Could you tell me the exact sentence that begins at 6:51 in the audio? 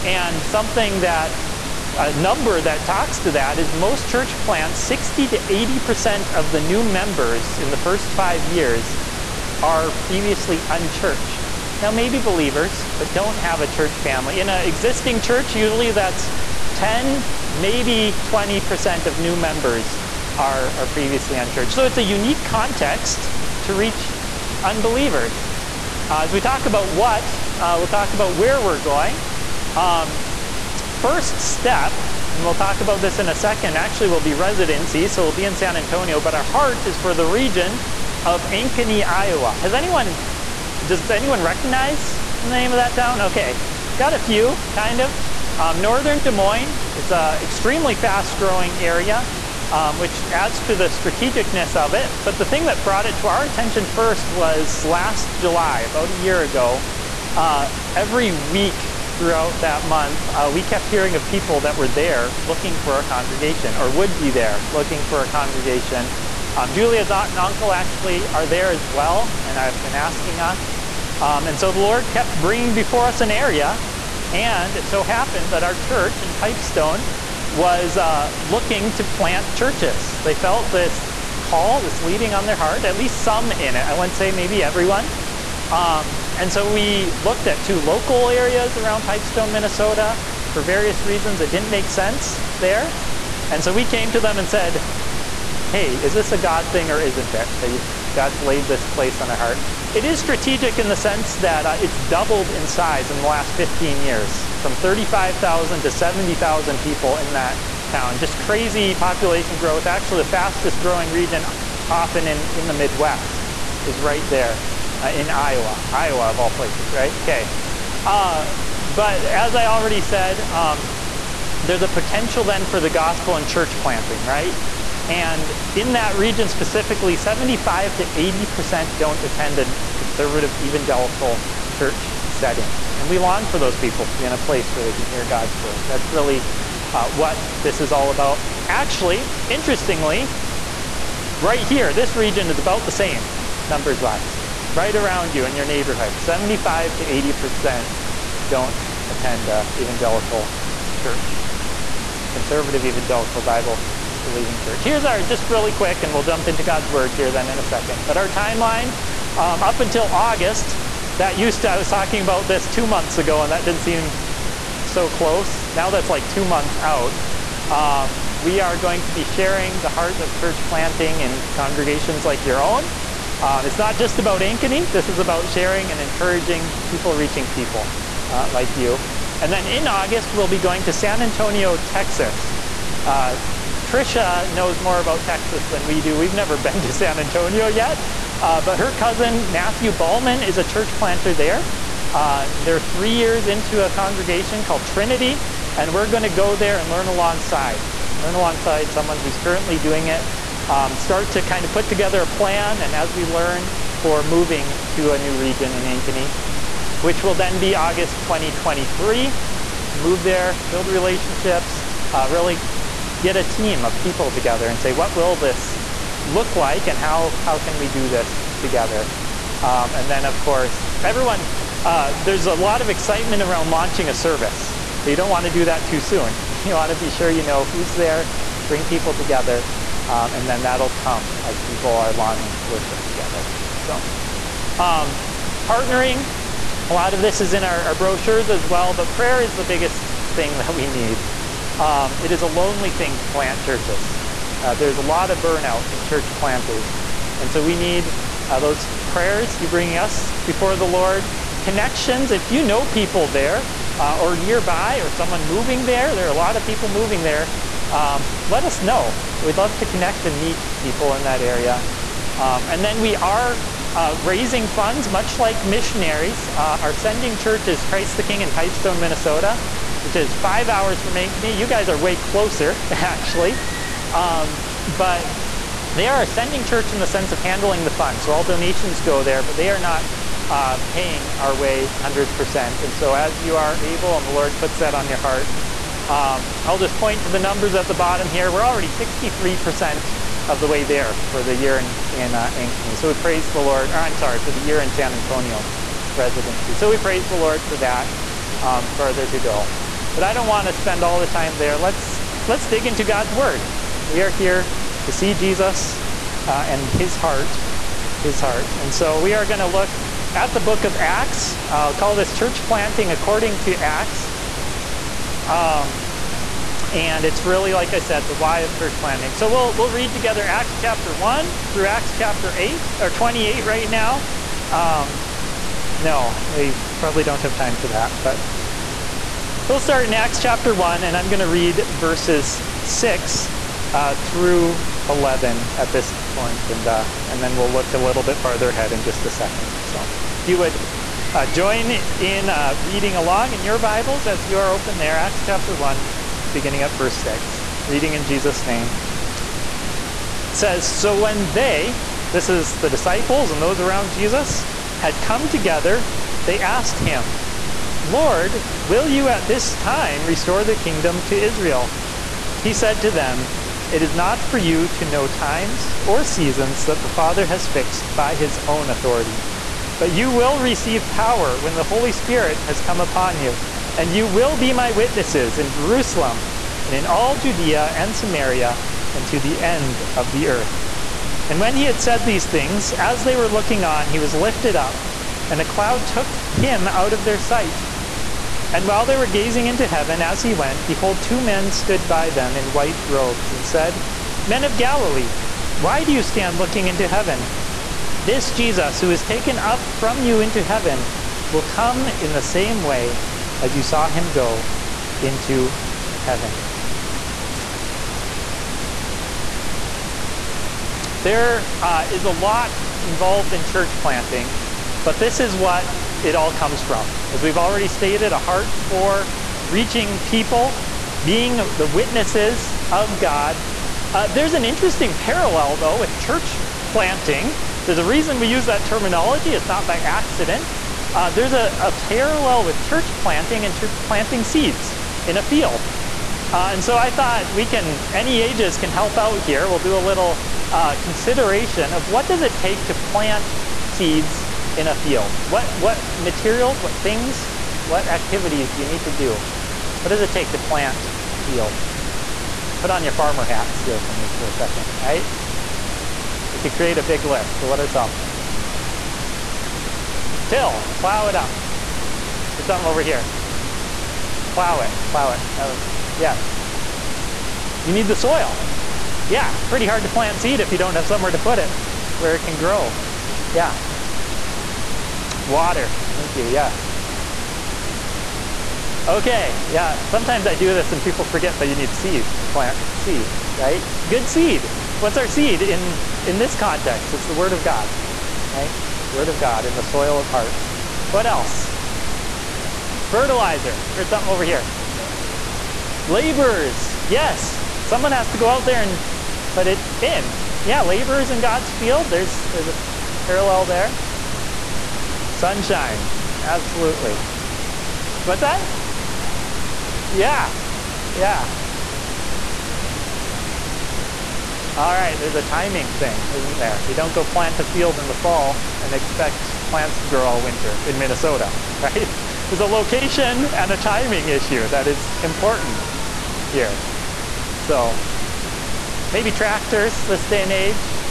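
There uh, is a lot involved in church planting, but this is what it all comes from.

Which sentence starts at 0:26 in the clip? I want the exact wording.
Uh, as we talk about what, uh, we'll talk about where we're going.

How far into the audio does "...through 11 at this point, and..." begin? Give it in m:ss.
5:34.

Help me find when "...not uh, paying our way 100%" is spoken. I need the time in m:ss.
4:39.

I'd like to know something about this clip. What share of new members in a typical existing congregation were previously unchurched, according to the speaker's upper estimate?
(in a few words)
20%.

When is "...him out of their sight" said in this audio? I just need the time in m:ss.
6:26.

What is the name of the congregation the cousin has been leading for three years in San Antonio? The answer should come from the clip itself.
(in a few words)
Trinity.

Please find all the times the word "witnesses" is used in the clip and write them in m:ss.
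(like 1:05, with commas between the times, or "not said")
6:14, 7:01.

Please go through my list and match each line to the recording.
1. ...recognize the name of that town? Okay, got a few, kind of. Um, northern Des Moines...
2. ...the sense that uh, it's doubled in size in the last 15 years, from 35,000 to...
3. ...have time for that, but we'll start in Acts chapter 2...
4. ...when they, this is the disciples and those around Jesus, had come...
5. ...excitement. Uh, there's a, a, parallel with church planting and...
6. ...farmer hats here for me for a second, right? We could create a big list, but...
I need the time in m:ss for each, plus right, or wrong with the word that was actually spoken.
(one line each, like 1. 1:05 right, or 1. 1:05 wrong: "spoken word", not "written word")
1. 0:41 right
2. 1:40 right
3. 5:27 wrong: "1", not "2"
4. 5:51 right
5. 7:09 wrong: "accident", not "excitement"
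6. 7:33 right.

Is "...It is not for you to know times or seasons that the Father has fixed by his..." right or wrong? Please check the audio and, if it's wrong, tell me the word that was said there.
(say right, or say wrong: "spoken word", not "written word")
right.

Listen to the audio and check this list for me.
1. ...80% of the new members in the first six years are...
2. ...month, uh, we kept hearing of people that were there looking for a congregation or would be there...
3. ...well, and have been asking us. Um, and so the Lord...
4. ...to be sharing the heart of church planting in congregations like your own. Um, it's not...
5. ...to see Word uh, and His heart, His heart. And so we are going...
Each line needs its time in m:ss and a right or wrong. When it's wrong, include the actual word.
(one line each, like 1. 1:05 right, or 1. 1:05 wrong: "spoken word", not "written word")
1. 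0:05 wrong: "five", not "six"
2. 0:59 right
3. 1:08 right
4. 2:49 right
5. 5:05 wrong: "Jesus", not "Word".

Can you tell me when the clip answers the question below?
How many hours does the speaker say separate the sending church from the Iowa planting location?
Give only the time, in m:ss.
4:30.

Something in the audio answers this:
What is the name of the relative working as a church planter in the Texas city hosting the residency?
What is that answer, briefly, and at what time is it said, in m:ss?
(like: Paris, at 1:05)
Matthew Ballman, at 3:09.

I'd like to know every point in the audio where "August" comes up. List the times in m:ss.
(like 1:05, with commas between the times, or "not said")
2:40, 2:59, 3:27.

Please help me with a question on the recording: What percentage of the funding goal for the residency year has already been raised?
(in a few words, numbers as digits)
63%.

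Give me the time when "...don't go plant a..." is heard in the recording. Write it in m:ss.
8:36.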